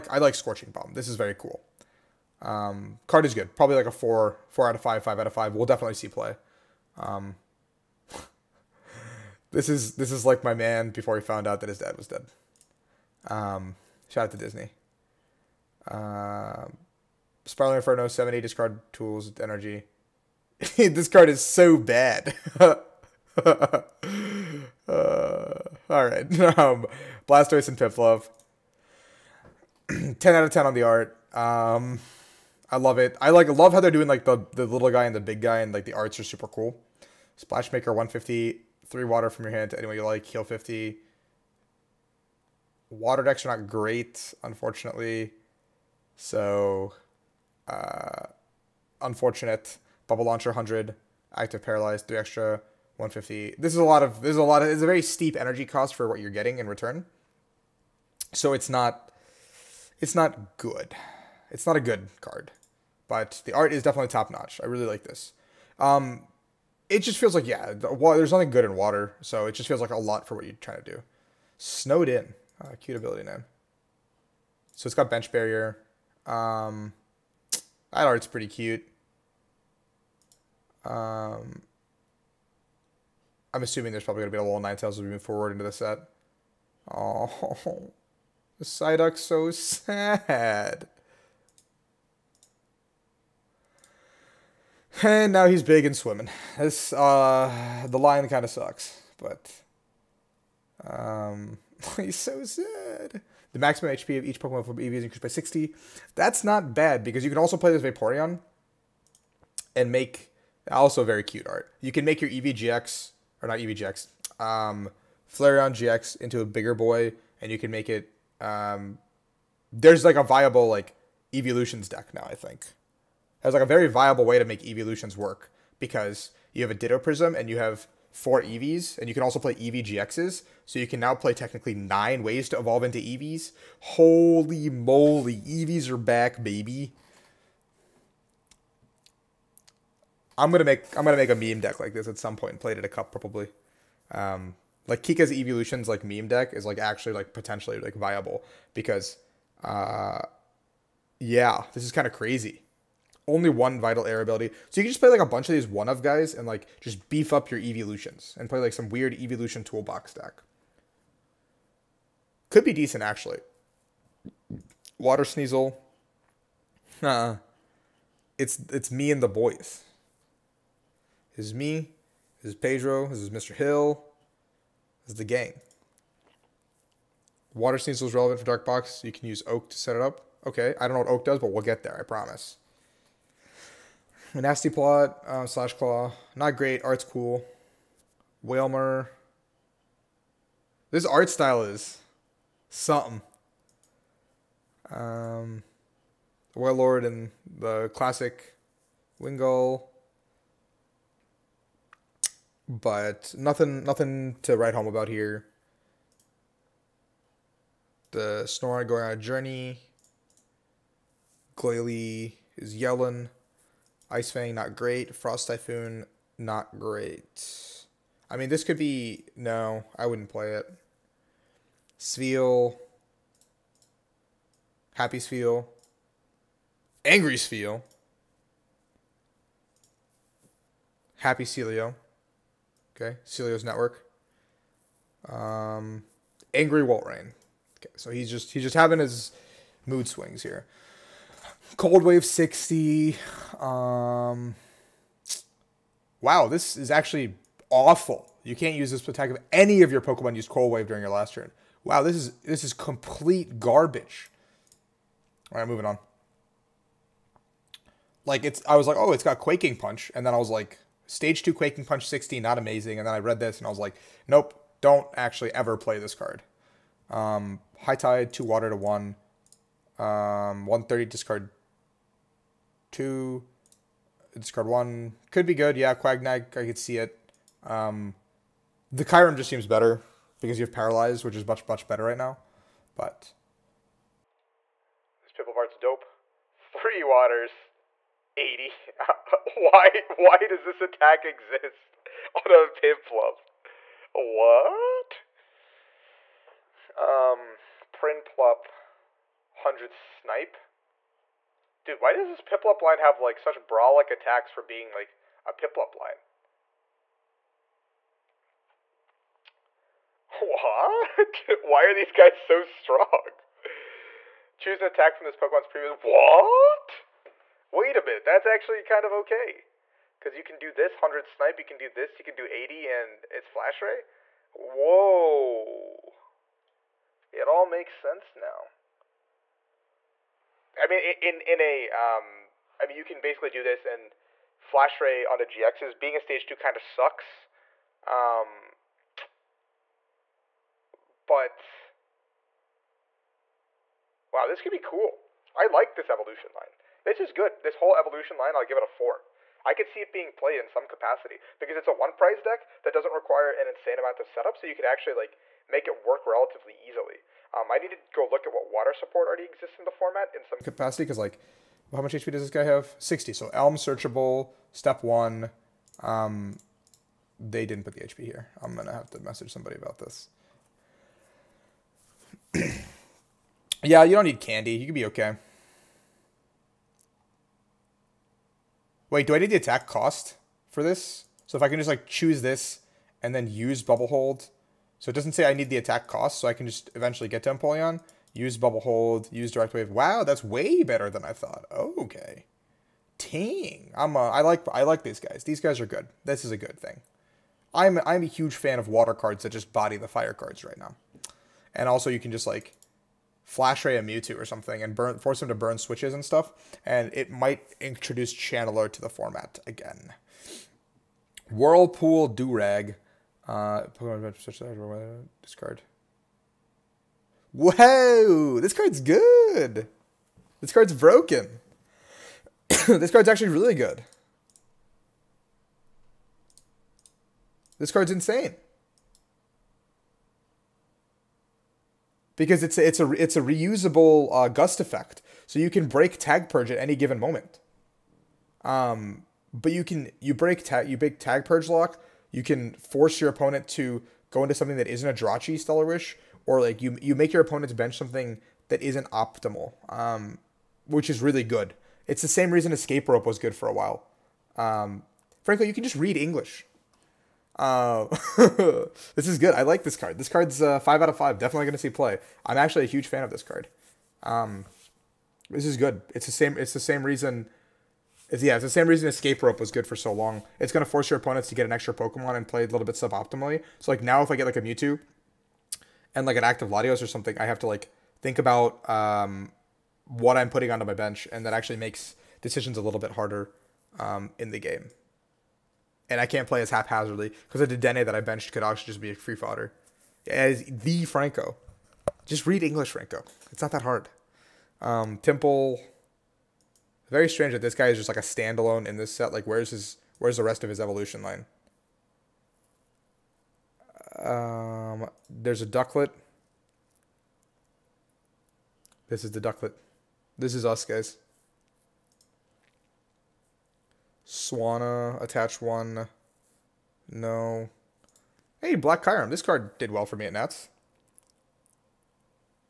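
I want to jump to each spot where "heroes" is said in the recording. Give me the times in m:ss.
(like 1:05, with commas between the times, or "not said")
not said.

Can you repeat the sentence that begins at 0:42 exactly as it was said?
Water decks are not great, unfortunately.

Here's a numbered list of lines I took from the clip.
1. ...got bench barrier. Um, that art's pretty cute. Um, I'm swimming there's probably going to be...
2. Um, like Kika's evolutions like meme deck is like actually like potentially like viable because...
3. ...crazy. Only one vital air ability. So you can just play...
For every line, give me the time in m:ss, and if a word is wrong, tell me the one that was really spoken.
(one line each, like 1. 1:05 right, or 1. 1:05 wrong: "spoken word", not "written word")
1. 1:14 wrong: "assuming", not "swimming"
2. 2:24 right
3. 2:32 right.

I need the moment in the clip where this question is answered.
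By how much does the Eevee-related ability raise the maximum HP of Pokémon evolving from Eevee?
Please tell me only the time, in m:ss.
1:45.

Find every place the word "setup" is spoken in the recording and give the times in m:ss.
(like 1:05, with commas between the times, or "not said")
5:54.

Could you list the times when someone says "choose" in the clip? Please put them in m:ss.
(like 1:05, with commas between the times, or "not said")
5:14, 6:22.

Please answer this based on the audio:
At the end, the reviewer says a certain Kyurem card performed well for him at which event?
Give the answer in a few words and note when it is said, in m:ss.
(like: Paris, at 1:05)
Nats, at 8:40.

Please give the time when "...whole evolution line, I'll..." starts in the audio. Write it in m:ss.
5:47.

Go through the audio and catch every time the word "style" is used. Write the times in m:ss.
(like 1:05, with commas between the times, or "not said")
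3:11.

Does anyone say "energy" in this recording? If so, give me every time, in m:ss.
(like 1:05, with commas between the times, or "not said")
0:19, 0:55.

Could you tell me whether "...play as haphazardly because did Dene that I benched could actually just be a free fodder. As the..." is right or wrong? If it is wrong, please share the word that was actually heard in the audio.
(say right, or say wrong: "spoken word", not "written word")
right.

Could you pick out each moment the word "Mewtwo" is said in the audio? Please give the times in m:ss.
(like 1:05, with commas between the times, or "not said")
6:44, 7:54.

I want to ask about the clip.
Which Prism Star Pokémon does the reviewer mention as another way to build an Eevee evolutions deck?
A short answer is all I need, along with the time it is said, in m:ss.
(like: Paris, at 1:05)
Ditto, at 2:06.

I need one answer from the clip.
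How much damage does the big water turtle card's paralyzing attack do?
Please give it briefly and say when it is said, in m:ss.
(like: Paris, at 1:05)
100, at 0:50.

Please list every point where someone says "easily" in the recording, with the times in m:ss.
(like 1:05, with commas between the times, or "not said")
5:56.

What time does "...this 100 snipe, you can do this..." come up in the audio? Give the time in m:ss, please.
5:20.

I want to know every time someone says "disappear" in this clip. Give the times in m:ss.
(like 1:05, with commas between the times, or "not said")
not said.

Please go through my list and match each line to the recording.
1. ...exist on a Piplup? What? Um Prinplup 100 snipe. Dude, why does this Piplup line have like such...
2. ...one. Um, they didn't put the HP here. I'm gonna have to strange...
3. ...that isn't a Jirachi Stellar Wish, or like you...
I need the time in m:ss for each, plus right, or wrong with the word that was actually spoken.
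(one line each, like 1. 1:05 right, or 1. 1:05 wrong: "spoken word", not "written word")
1. 4:51 right
2. 6:05 wrong: "message", not "strange"
3. 7:24 right.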